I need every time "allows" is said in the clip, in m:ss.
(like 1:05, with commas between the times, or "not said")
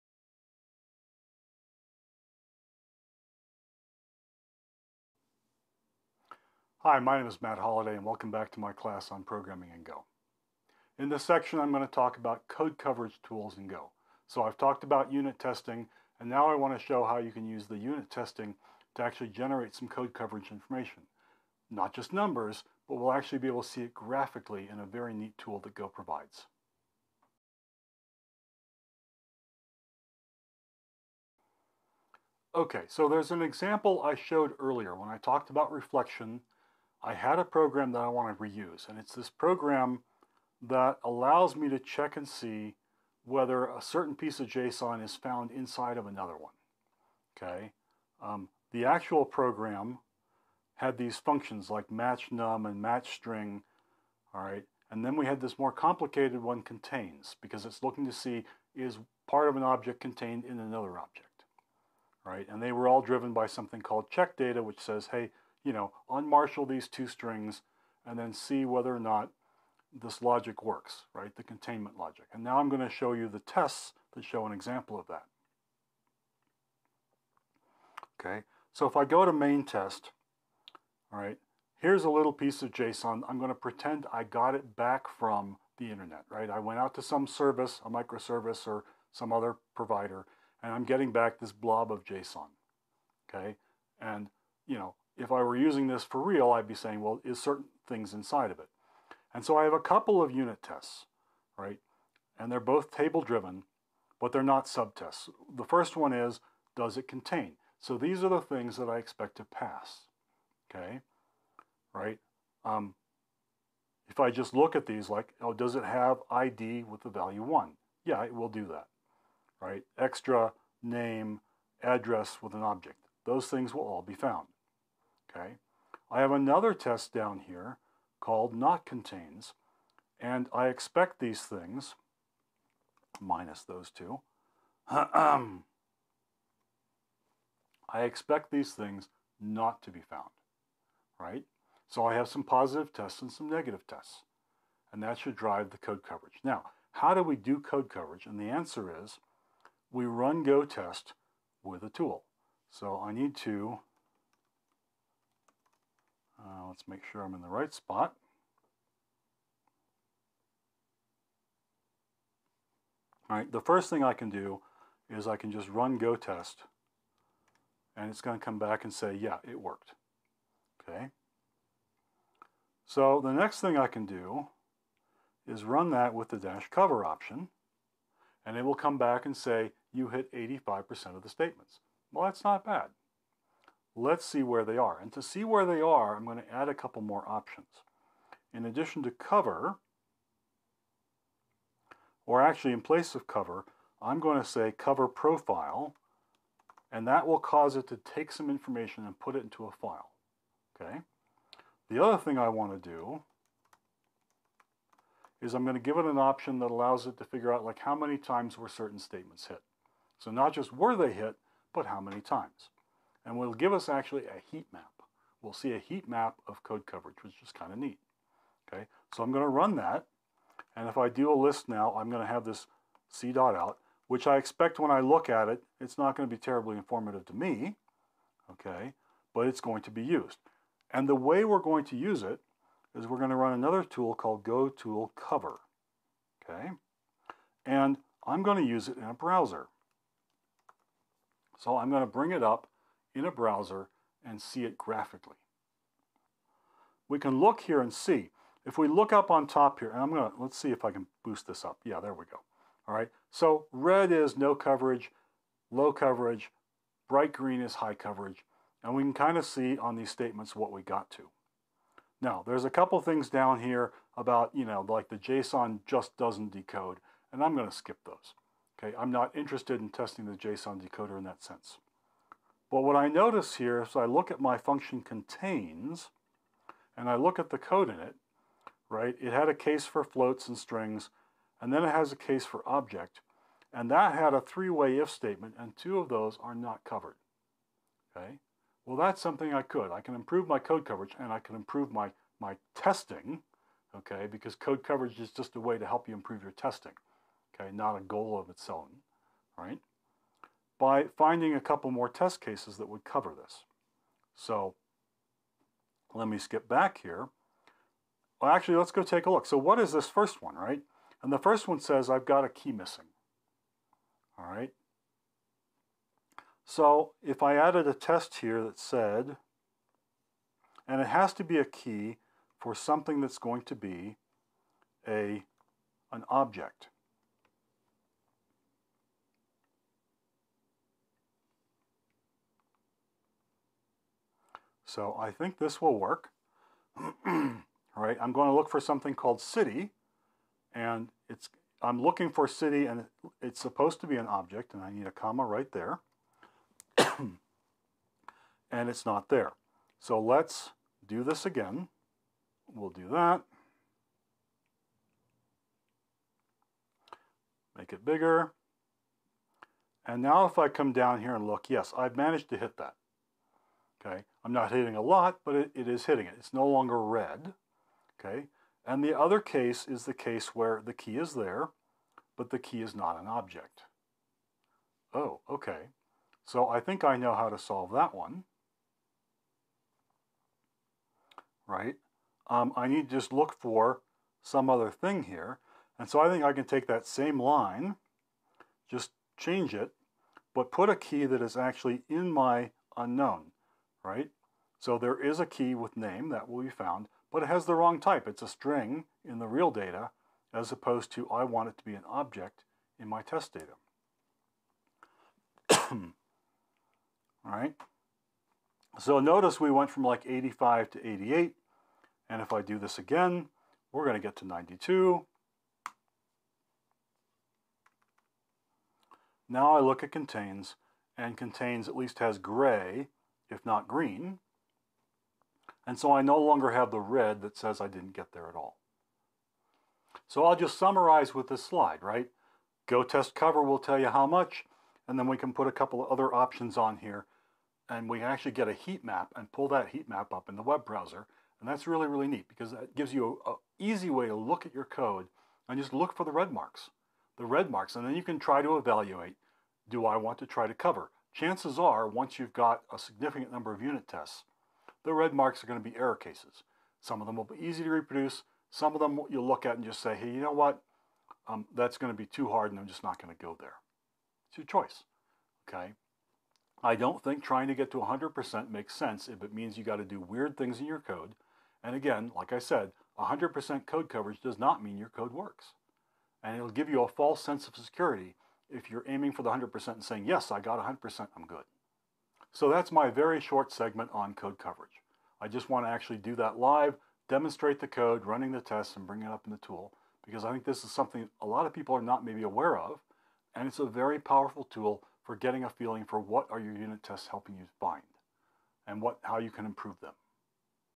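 0:41, 3:26.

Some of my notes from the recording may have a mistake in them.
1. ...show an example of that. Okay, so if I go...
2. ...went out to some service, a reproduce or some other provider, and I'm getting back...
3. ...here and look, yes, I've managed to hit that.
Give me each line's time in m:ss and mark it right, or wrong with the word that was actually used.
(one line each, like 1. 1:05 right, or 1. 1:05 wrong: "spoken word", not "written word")
1. 1:14 right
2. 1:26 wrong: "microservice", not "reproduce"
3. 6:01 right.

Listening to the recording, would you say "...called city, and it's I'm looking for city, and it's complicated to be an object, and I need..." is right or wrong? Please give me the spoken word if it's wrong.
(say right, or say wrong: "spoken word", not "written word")
wrong: "supposed", not "complicated".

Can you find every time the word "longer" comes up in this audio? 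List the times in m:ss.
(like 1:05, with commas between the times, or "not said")
6:06, 7:06.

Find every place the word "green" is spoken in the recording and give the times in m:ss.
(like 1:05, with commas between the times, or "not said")
4:17, 7:03.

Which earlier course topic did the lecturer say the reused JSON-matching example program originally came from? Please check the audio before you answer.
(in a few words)
Reflection.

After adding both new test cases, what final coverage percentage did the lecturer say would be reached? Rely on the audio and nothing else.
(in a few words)
92%.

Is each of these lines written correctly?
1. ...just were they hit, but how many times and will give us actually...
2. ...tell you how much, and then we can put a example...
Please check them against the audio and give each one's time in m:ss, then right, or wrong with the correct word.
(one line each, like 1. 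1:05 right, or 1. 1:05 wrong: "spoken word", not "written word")
1. 3:30 right
2. 7:13 wrong: "couple", not "example".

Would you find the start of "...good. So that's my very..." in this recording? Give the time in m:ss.
8:01.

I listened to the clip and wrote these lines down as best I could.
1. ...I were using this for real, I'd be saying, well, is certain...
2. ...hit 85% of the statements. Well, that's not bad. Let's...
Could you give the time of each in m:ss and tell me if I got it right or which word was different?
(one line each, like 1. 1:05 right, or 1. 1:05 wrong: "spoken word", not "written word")
1. 1:35 right
2. 3:00 right.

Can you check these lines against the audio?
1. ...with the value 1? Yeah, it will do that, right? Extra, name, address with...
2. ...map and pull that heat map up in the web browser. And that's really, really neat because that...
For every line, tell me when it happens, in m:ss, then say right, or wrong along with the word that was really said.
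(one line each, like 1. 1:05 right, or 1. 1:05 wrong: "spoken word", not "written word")
1. 1:56 right
2. 7:19 right.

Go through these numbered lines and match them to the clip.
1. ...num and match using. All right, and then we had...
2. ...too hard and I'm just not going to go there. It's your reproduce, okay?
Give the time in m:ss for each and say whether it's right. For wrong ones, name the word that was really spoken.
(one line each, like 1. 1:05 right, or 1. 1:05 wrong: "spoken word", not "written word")
1. 0:52 wrong: "string", not "using"
2. 7:42 wrong: "choice", not "reproduce".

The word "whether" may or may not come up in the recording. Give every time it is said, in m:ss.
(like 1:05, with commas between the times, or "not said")
0:43, 1:08.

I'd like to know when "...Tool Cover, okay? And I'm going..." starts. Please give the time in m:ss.
3:54.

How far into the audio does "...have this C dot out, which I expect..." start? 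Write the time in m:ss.
3:42.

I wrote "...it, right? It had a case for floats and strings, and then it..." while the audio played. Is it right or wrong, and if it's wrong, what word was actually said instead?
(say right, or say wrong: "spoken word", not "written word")
right.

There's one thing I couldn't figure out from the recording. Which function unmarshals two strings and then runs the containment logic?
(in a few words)
check data.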